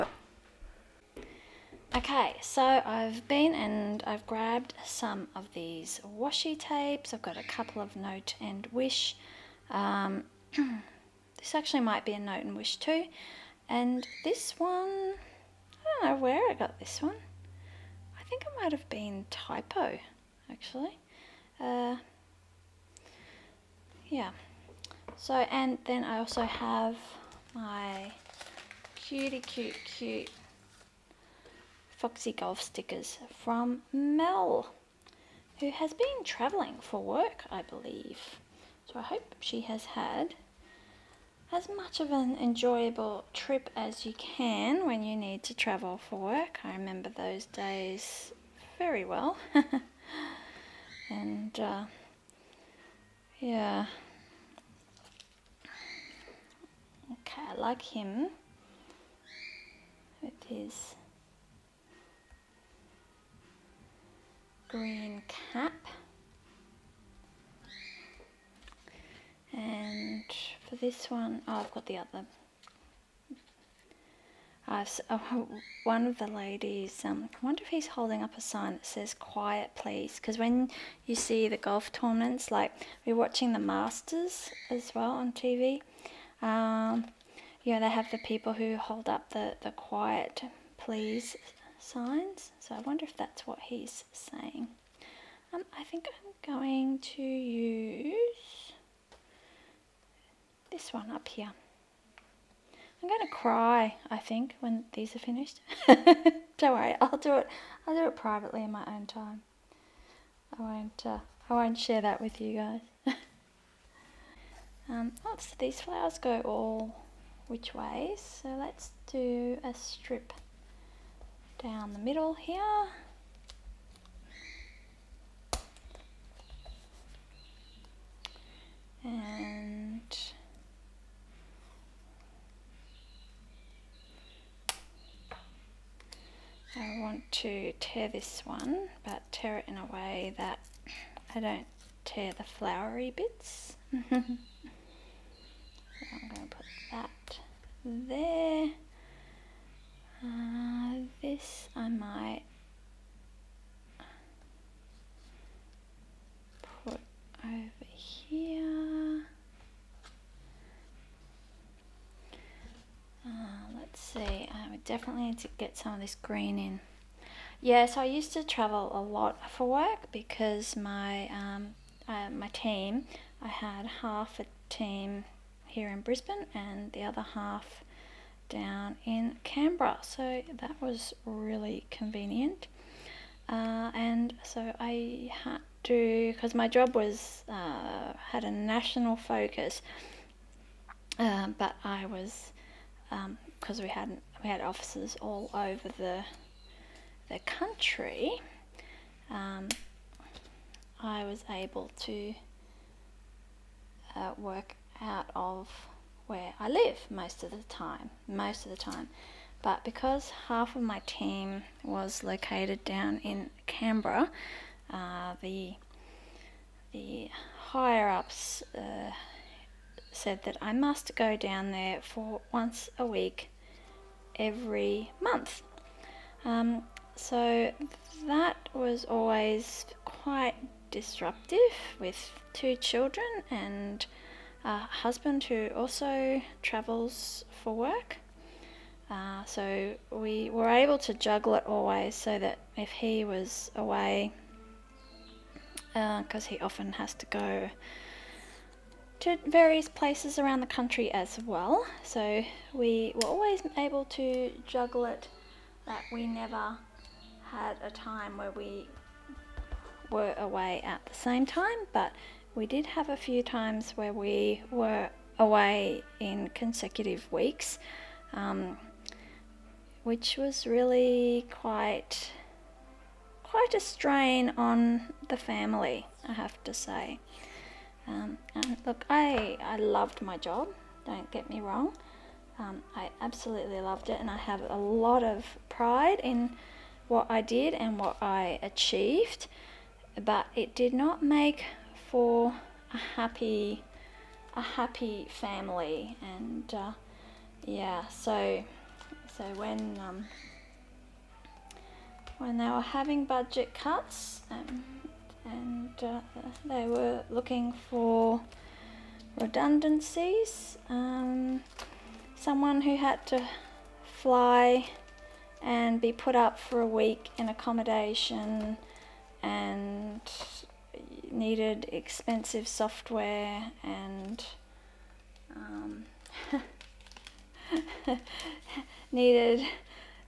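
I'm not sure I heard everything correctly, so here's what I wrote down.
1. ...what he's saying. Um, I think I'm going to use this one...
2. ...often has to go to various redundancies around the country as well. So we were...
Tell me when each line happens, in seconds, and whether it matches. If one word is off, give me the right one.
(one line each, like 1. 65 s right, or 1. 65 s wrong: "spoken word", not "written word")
1. 93 s right
2. 246 s wrong: "places", not "redundancies".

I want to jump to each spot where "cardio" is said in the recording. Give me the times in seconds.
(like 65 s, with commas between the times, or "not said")
not said.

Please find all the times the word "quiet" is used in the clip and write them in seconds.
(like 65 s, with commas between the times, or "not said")
79 s, 89 s.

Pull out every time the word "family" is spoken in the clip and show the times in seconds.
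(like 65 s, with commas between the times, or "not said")
275 s, 295 s.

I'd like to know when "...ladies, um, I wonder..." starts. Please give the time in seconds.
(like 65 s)
76 s.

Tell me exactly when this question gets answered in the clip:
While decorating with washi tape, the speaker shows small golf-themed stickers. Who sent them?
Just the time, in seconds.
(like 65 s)
33 s.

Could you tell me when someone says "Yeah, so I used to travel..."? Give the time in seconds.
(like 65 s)
167 s.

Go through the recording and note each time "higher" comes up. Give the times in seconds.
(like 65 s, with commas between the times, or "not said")
217 s.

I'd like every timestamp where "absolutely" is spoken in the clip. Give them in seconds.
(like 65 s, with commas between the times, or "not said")
283 s.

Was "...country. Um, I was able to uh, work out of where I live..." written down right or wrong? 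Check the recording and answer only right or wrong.
right.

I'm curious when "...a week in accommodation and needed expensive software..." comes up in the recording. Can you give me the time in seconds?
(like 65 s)
316 s.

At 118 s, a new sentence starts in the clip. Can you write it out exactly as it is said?
So let's do a strip down the middle here.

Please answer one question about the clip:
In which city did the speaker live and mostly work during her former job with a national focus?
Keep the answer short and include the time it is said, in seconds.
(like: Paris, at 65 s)
Brisbane, at 175 s.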